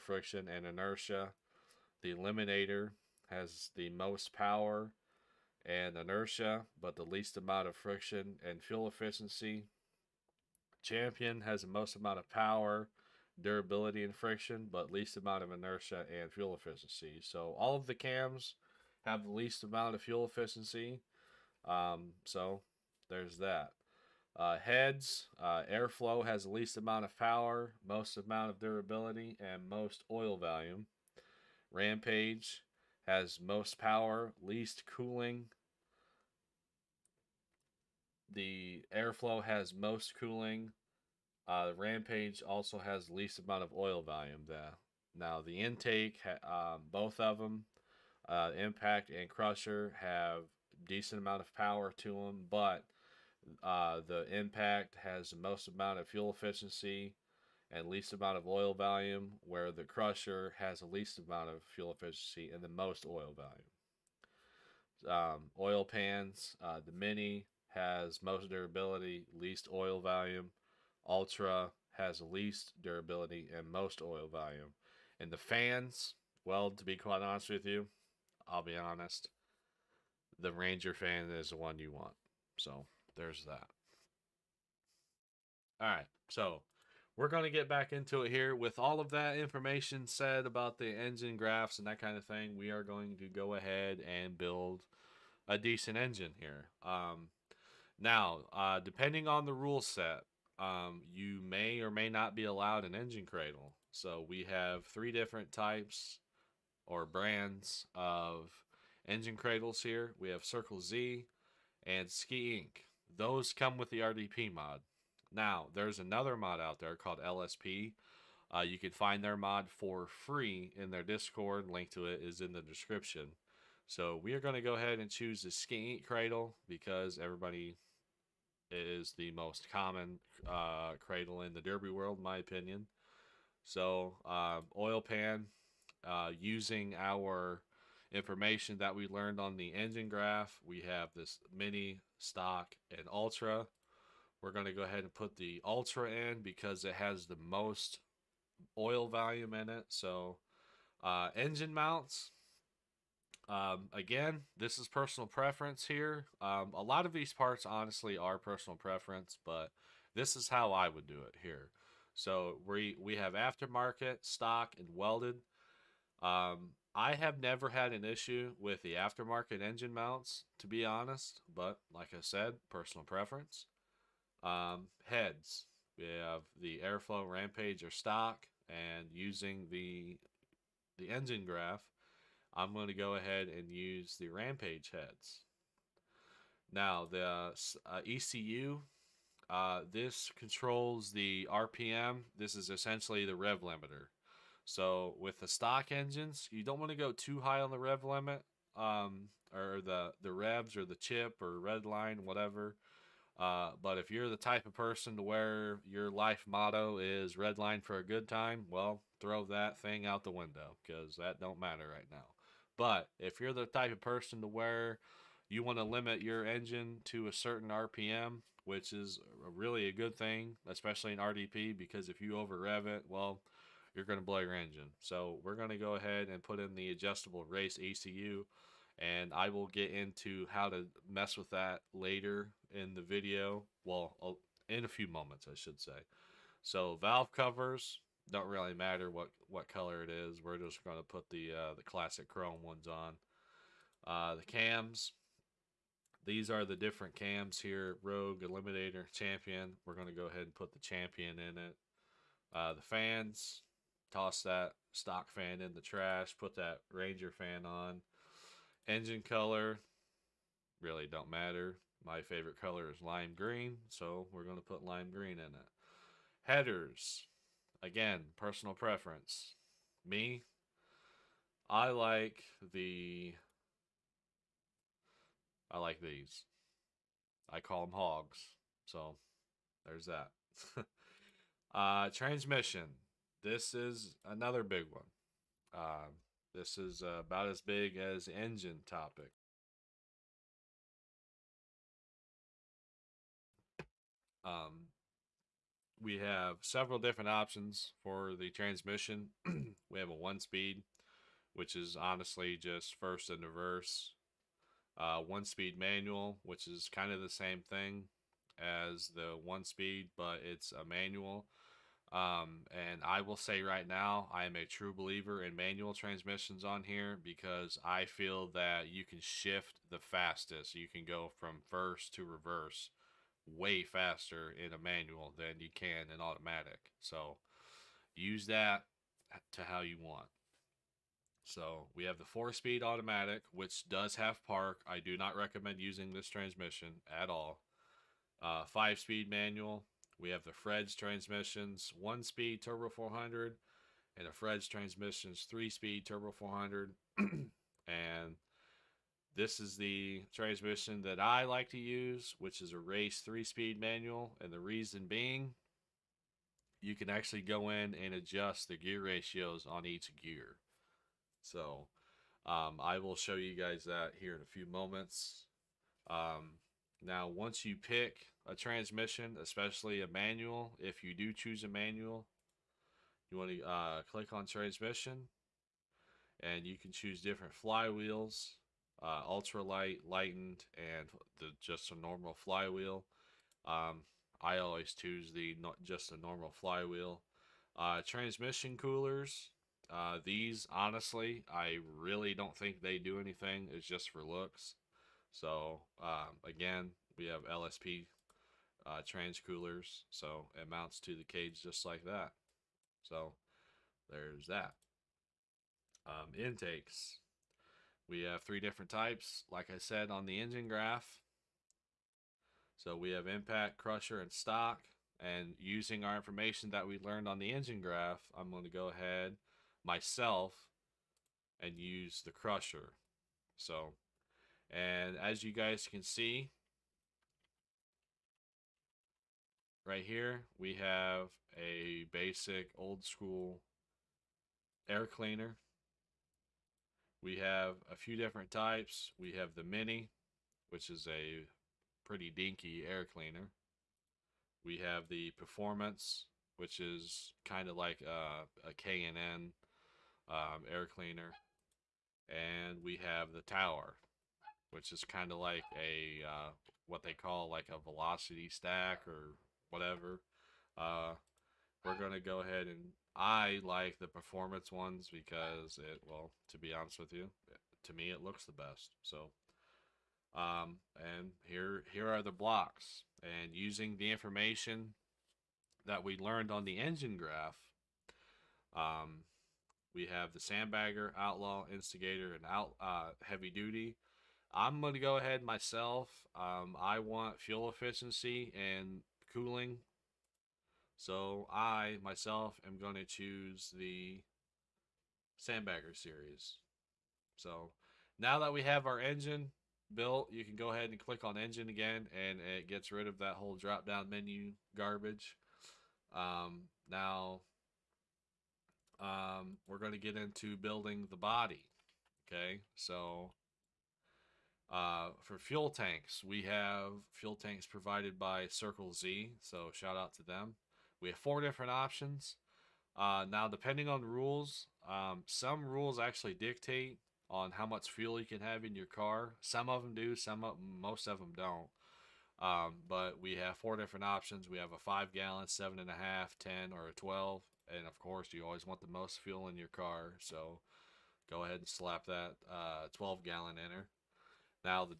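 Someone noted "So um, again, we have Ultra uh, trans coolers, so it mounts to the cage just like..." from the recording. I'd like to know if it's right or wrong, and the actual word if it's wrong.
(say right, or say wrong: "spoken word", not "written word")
wrong: "LSP", not "Ultra".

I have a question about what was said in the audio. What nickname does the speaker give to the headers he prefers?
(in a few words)
Hogs.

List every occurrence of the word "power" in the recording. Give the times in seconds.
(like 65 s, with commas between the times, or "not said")
4 s, 12 s, 27 s, 33 s, 51 s.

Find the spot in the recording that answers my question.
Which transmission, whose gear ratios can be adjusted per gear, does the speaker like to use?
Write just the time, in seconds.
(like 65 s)
352 s.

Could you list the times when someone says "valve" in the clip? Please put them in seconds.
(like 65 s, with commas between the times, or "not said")
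236 s.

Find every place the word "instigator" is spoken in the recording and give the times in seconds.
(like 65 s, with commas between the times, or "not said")
481 s.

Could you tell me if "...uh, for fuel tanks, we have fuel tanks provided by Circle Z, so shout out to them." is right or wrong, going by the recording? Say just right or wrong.
right.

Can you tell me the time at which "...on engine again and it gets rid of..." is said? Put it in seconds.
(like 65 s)
501 s.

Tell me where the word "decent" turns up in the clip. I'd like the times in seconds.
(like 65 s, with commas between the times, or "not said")
50 s, 95 s.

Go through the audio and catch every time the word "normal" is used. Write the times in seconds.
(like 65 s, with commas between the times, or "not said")
381 s, 386 s.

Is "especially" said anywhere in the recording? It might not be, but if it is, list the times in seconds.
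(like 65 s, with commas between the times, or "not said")
220 s, 369 s.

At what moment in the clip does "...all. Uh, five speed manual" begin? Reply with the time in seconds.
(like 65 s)
337 s.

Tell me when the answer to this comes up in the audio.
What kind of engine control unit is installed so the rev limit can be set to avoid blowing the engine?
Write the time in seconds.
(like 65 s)
226 s.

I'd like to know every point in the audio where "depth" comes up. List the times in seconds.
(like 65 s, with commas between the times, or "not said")
not said.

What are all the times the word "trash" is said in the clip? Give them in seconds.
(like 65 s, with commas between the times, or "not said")
255 s.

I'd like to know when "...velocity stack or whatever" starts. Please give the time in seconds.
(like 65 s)
457 s.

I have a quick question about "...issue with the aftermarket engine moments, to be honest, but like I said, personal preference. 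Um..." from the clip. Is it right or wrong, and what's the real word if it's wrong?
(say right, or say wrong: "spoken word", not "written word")
wrong: "mounts", not "moments".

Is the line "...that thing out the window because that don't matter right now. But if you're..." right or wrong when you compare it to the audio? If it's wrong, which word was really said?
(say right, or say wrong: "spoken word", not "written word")
right.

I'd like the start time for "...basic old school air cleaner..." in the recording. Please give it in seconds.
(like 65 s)
432 s.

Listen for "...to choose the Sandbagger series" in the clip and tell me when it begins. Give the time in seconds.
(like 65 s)
492 s.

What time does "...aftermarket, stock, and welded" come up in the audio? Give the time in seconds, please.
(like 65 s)
163 s.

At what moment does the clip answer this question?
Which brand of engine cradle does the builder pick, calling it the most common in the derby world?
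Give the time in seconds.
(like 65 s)
125 s.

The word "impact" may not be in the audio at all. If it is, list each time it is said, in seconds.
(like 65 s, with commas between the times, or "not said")
48 s, 54 s, 413 s.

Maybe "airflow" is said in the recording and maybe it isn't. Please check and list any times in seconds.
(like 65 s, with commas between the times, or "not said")
25 s, 38 s, 176 s.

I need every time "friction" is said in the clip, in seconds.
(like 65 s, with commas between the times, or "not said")
0 s, 7 s, 14 s.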